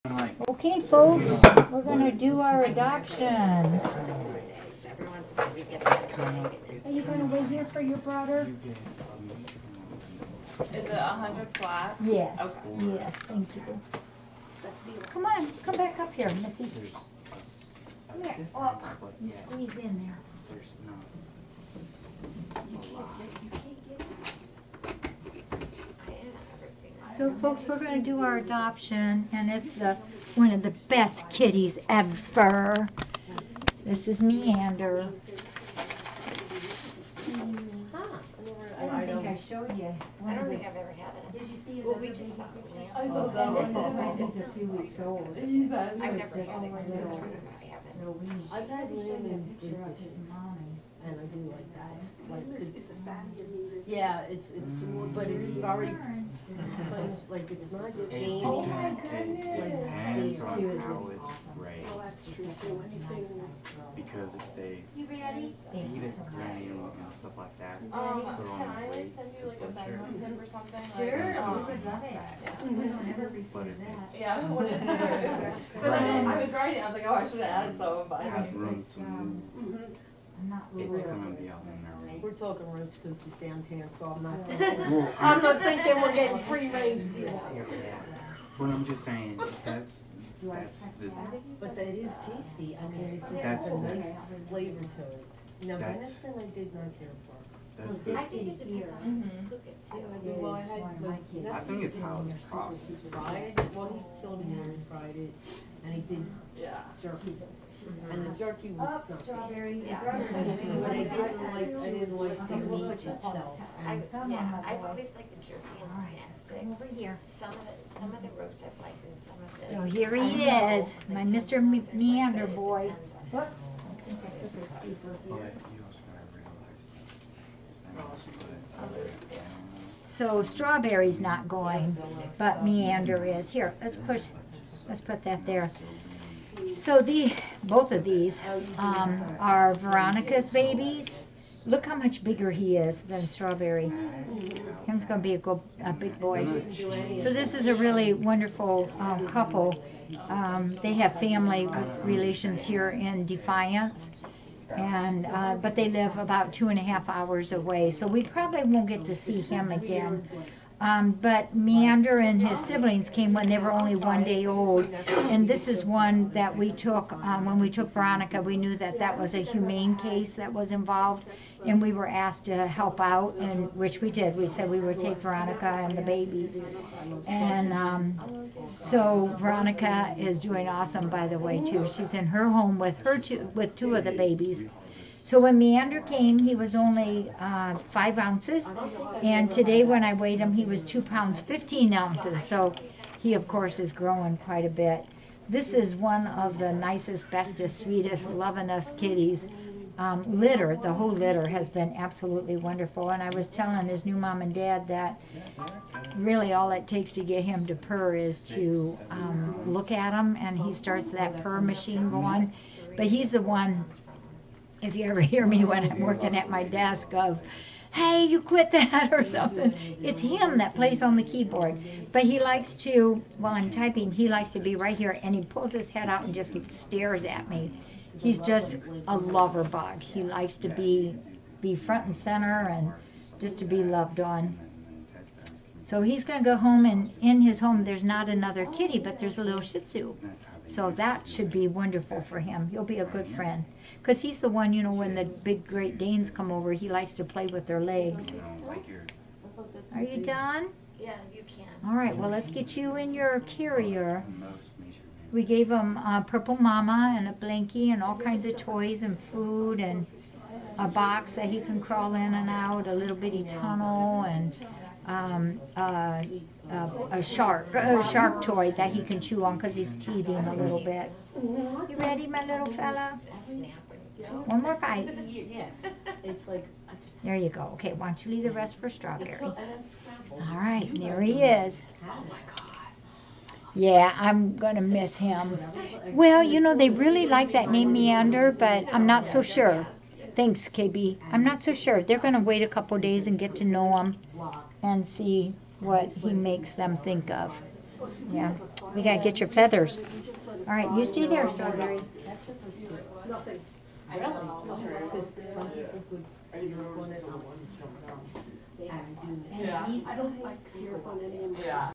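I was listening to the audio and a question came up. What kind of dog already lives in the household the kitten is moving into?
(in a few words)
Shih Tzu.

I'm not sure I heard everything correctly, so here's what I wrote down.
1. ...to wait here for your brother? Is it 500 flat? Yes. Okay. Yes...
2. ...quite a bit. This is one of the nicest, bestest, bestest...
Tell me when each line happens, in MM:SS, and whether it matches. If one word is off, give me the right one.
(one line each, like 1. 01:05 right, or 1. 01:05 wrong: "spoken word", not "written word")
1. 00:07 wrong: "100", not "500"
2. 03:14 wrong: "sweetest", not "bestest".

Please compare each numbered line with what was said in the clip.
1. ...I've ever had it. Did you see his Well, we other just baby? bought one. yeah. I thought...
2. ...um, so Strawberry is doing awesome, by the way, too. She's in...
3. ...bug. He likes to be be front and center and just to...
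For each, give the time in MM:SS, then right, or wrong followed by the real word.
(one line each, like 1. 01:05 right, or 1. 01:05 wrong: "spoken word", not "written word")
1. 00:40 right
2. 02:57 wrong: "Veronica", not "Strawberry"
3. 03:49 right.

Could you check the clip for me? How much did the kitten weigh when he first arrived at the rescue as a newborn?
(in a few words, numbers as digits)
5 ounces.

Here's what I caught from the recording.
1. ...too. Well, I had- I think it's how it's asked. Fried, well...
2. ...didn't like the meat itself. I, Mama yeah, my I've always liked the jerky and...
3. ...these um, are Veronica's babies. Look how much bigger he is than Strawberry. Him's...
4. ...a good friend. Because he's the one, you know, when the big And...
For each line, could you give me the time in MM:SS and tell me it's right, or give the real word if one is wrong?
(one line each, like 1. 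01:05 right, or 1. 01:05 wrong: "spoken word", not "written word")
1. 01:39 wrong: "processed", not "asked"
2. 01:51 wrong: "Come", not "Mama"
3. 02:18 right
4. 04:02 wrong: "Great", not "And".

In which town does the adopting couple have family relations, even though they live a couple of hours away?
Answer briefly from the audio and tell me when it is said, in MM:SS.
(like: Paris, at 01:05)
Defiance, at 02:33.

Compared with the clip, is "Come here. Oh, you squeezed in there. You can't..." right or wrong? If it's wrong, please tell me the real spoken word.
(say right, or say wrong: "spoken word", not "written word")
right.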